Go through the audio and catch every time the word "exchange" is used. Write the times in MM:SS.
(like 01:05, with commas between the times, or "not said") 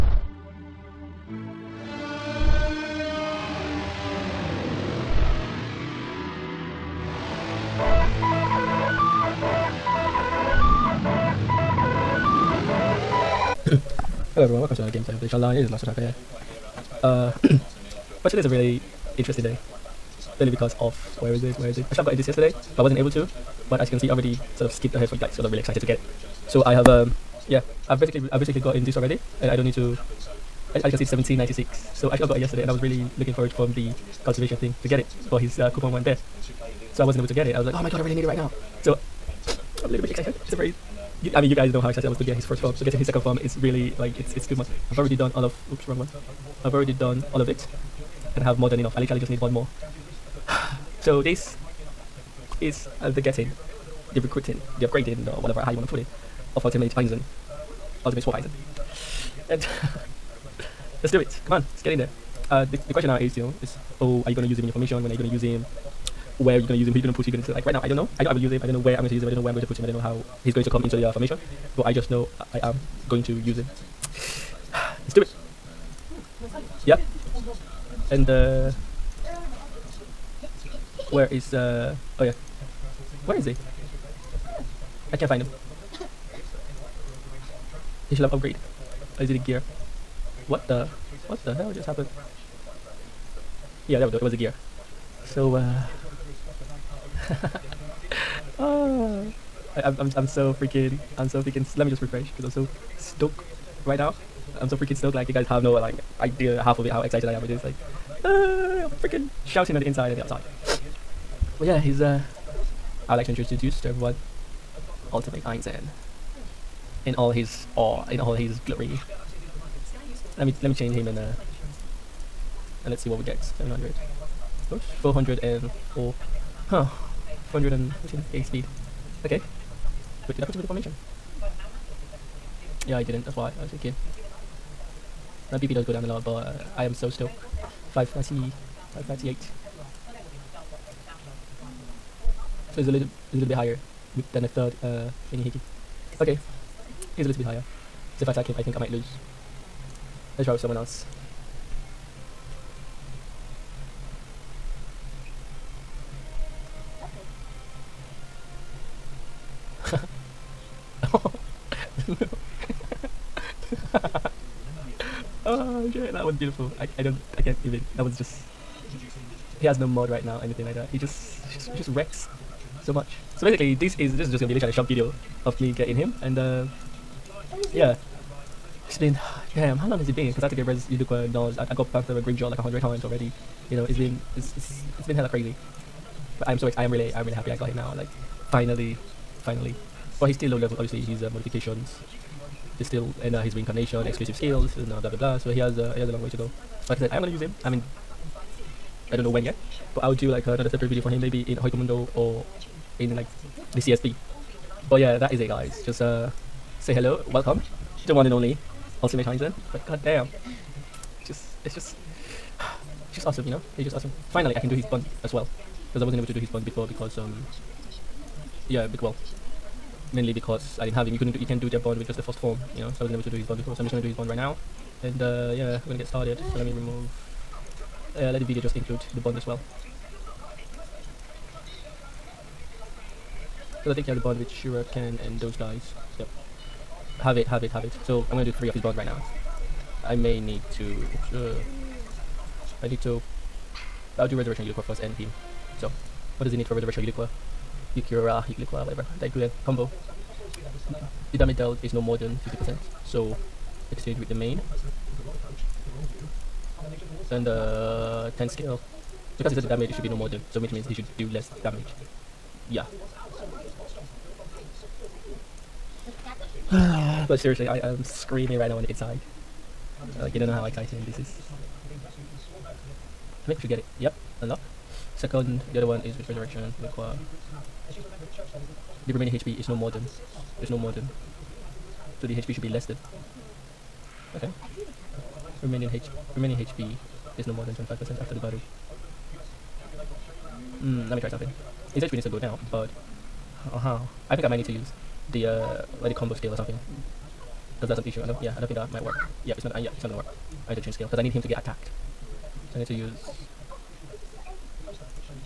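04:13.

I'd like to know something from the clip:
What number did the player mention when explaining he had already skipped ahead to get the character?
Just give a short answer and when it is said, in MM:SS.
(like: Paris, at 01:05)
1796, at 00:31.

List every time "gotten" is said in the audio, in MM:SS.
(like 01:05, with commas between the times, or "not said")
00:22, 00:28.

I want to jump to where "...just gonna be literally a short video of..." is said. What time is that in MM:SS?
02:54.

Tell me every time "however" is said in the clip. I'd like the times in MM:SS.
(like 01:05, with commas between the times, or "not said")
not said.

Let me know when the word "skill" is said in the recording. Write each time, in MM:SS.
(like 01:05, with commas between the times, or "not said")
03:14, 04:18, 04:56, 05:00.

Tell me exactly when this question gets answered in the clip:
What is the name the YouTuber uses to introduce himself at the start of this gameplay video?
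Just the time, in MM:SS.
00:15.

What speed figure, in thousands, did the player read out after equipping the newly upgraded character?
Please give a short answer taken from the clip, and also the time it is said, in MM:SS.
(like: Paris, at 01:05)
414k, at 02:07.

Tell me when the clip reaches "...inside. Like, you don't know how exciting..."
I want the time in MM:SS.
04:28.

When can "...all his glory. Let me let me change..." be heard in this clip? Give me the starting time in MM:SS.
01:58.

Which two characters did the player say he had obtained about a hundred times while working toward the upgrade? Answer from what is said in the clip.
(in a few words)
Panther and Grimmjow.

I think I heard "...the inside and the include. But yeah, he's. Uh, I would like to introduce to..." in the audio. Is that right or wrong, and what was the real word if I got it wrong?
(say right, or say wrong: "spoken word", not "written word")
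wrong: "outside", not "include".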